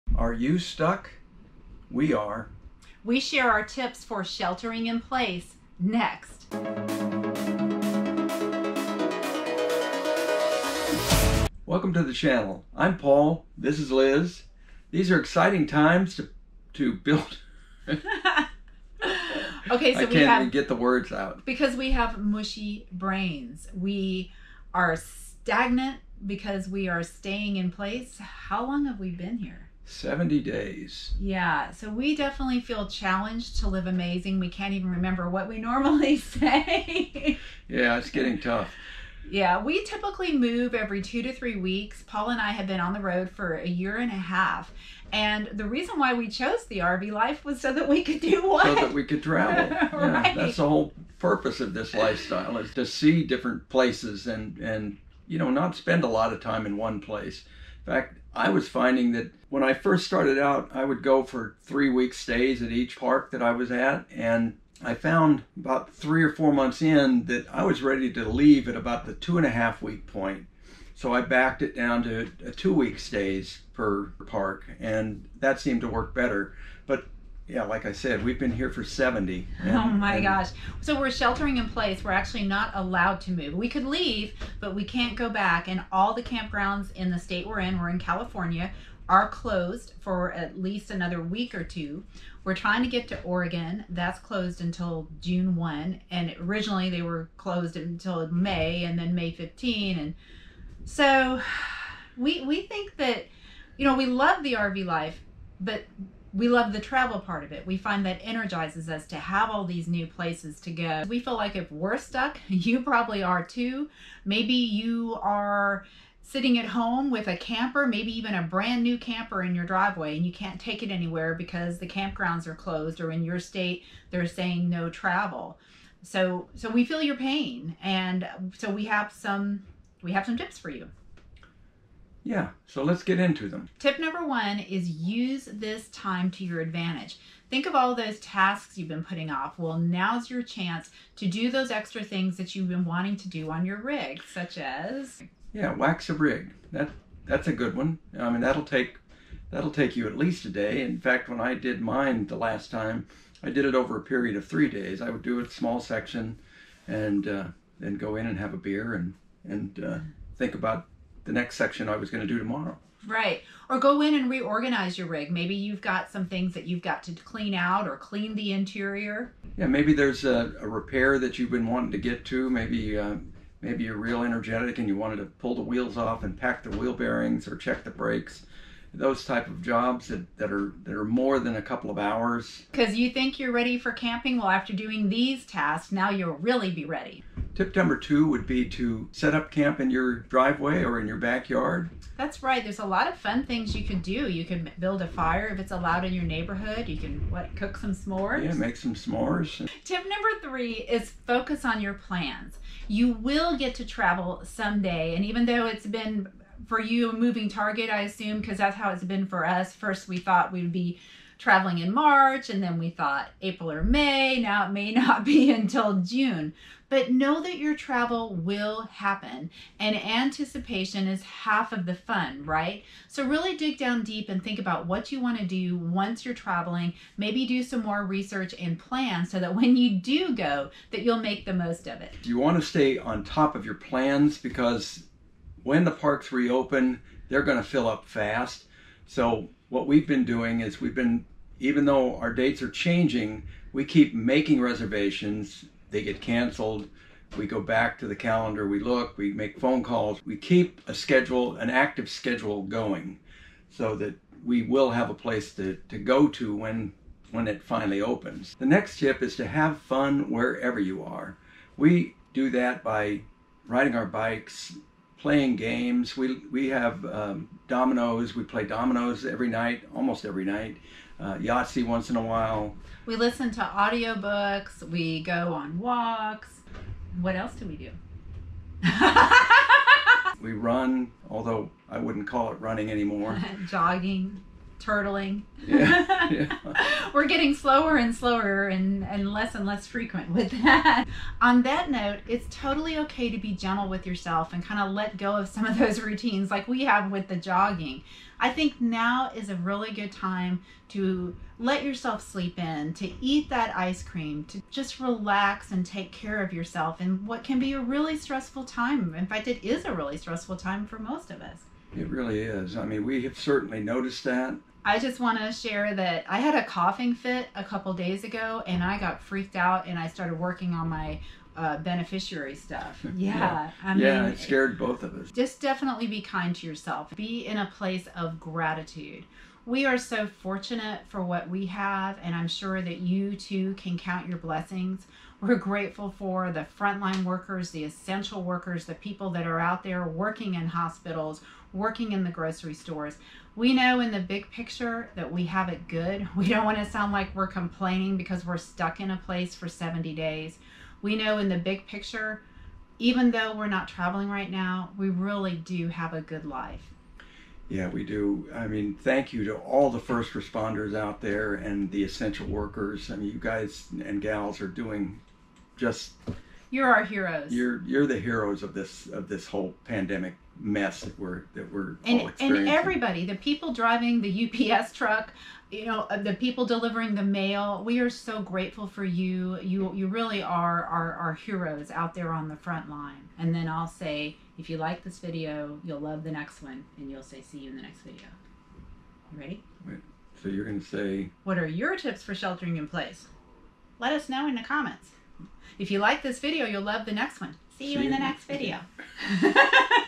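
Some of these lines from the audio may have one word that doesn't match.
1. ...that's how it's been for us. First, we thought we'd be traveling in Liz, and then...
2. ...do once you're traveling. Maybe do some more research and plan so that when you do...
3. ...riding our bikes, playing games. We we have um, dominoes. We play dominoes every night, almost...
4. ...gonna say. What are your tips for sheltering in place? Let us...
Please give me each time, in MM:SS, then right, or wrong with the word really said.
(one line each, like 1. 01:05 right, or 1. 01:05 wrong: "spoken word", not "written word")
1. 03:28 wrong: "March", not "Liz"
2. 03:45 right
3. 04:23 right
4. 06:30 right.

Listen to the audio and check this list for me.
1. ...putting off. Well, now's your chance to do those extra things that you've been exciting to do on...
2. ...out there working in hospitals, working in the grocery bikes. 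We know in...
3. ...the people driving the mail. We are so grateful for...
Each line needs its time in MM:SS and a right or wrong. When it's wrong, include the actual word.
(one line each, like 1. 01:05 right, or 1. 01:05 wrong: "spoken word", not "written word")
1. 02:19 wrong: "wanting", not "exciting"
2. 05:39 wrong: "stores", not "bikes"
3. 06:16 wrong: "delivering", not "driving".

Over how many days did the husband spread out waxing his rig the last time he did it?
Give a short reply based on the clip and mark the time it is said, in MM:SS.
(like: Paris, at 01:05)
3 days, at 02:34.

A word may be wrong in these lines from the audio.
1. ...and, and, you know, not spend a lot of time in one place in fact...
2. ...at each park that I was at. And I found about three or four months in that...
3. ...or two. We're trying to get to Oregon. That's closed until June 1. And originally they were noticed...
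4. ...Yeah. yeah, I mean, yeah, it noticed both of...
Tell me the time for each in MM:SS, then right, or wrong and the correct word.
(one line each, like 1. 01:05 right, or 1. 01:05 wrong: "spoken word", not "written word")
1. 00:54 right
2. 01:02 right
3. 01:31 wrong: "closed", not "noticed"
4. 05:23 wrong: "scared", not "noticed".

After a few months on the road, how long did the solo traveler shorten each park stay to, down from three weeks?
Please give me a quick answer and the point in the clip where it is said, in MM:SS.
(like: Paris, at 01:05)
2 weeks, at 01:12.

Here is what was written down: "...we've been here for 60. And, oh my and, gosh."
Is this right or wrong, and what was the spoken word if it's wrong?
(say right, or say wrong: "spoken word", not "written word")
wrong: "70", not "60".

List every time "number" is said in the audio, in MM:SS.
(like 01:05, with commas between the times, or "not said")
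02:13, 03:07, 03:20.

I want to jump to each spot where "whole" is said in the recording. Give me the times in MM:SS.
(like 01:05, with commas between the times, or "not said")
00:50, 06:09.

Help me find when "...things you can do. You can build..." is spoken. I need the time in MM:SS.
03:13.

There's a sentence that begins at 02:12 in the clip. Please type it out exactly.
Yeah, so let's get into them.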